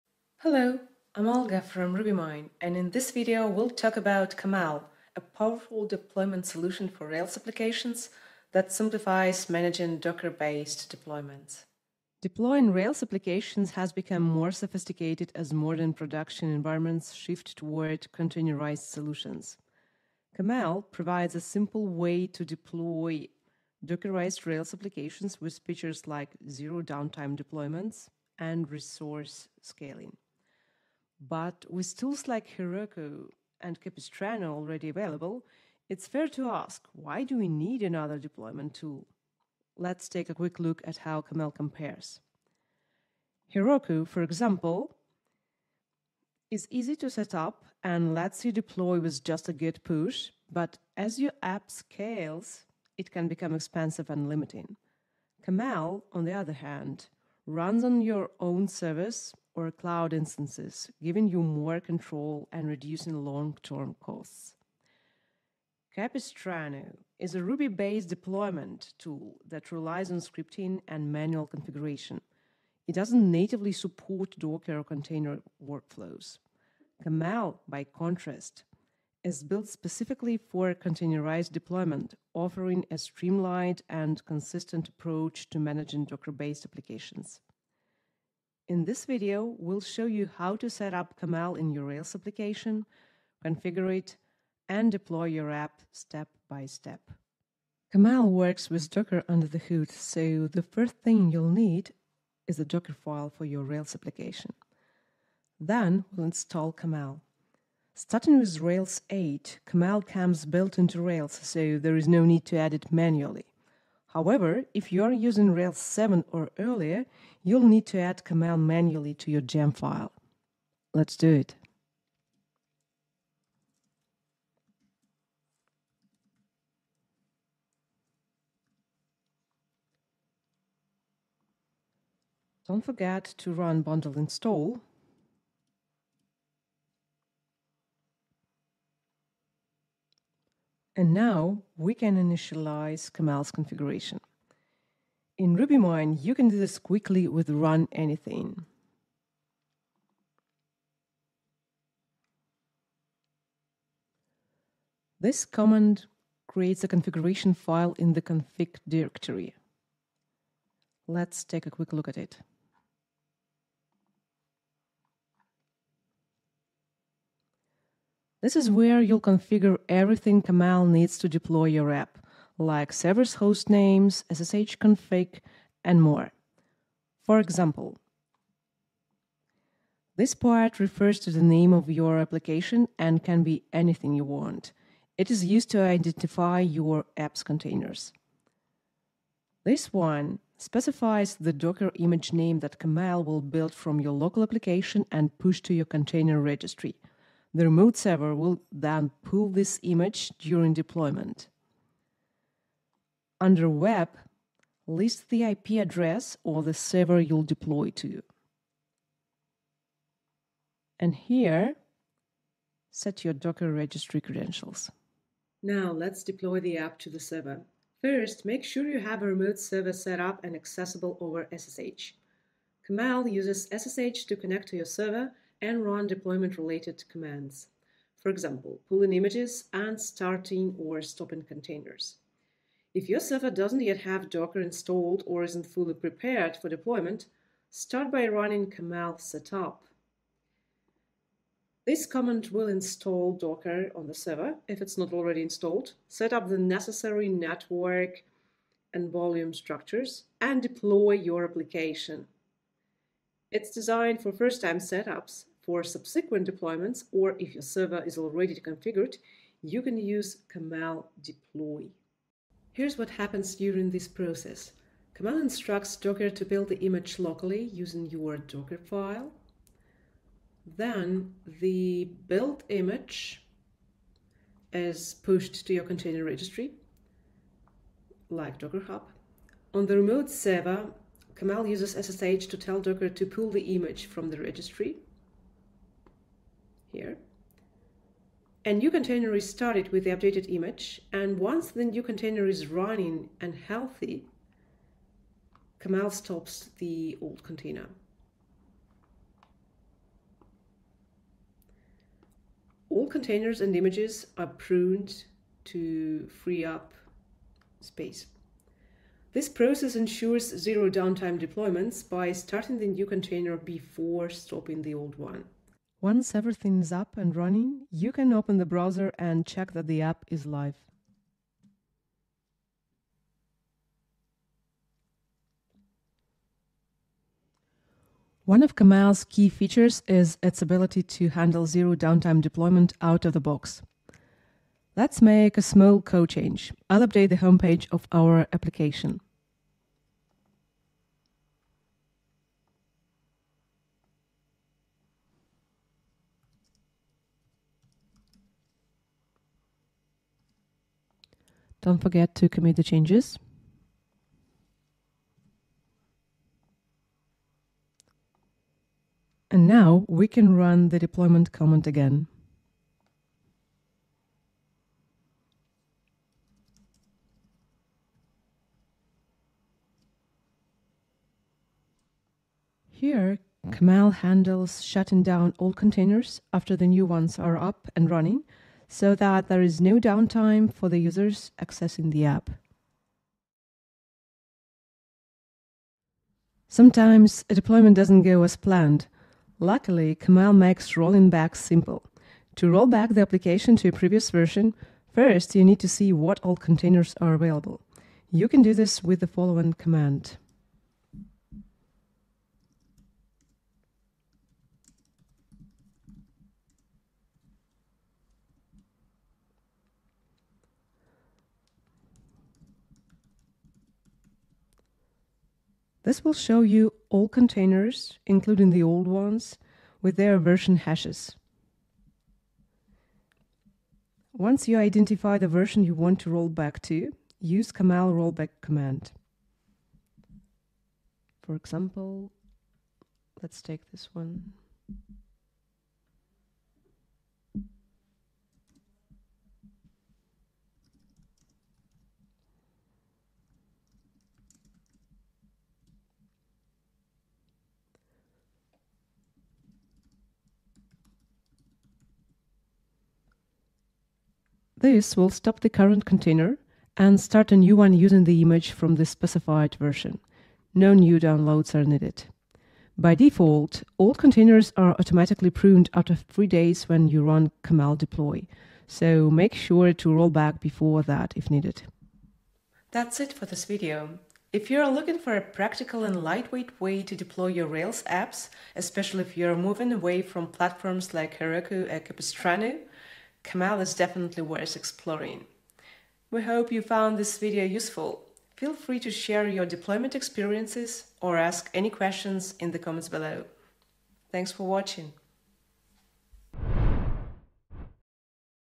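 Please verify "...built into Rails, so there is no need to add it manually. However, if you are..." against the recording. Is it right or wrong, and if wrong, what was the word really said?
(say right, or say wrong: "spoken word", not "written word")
right.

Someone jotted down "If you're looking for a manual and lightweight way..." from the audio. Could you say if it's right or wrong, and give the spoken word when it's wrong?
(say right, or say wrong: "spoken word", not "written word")
wrong: "practical", not "manual".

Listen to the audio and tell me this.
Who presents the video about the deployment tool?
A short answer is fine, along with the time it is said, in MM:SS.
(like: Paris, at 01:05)
Olga, at 00:01.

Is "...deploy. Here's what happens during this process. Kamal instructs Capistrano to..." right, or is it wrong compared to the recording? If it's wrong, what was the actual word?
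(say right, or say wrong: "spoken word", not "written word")
wrong: "Docker", not "Capistrano".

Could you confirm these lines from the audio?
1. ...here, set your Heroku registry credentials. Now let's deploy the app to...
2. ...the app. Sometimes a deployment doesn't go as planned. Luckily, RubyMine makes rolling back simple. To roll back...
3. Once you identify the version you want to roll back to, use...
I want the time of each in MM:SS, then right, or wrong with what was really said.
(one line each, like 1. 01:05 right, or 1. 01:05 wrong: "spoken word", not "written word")
1. 03:31 wrong: "Docker", not "Heroku"
2. 06:22 wrong: "Kamal", not "RubyMine"
3. 07:04 right.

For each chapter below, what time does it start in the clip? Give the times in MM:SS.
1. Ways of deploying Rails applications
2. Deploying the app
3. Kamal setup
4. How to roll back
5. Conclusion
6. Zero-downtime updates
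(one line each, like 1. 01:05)
1. 00:12
2. 03:35
3. 01:38
4. 06:26
5. 07:53
6. 05:28.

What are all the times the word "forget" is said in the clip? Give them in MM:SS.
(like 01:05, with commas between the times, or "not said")
02:12, 05:51.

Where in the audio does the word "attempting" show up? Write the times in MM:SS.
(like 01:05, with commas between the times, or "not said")
not said.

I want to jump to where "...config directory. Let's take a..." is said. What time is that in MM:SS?
02:38.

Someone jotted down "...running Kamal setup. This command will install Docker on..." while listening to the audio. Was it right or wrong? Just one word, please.
right.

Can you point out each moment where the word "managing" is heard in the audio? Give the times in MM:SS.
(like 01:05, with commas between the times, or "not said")
00:09, 01:25.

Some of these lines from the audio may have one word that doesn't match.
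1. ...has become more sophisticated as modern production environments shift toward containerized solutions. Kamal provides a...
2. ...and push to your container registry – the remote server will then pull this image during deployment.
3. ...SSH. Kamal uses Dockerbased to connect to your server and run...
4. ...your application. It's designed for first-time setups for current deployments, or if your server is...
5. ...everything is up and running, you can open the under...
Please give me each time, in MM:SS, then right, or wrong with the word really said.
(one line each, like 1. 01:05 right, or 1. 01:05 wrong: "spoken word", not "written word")
1. 00:13 right
2. 03:15 right
3. 03:41 wrong: "SSH", not "Dockerbased"
4. 04:11 wrong: "subsequent", not "current"
5. 05:16 wrong: "browser", not "under".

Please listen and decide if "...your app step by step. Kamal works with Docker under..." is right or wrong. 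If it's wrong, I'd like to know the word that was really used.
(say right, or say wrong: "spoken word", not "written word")
right.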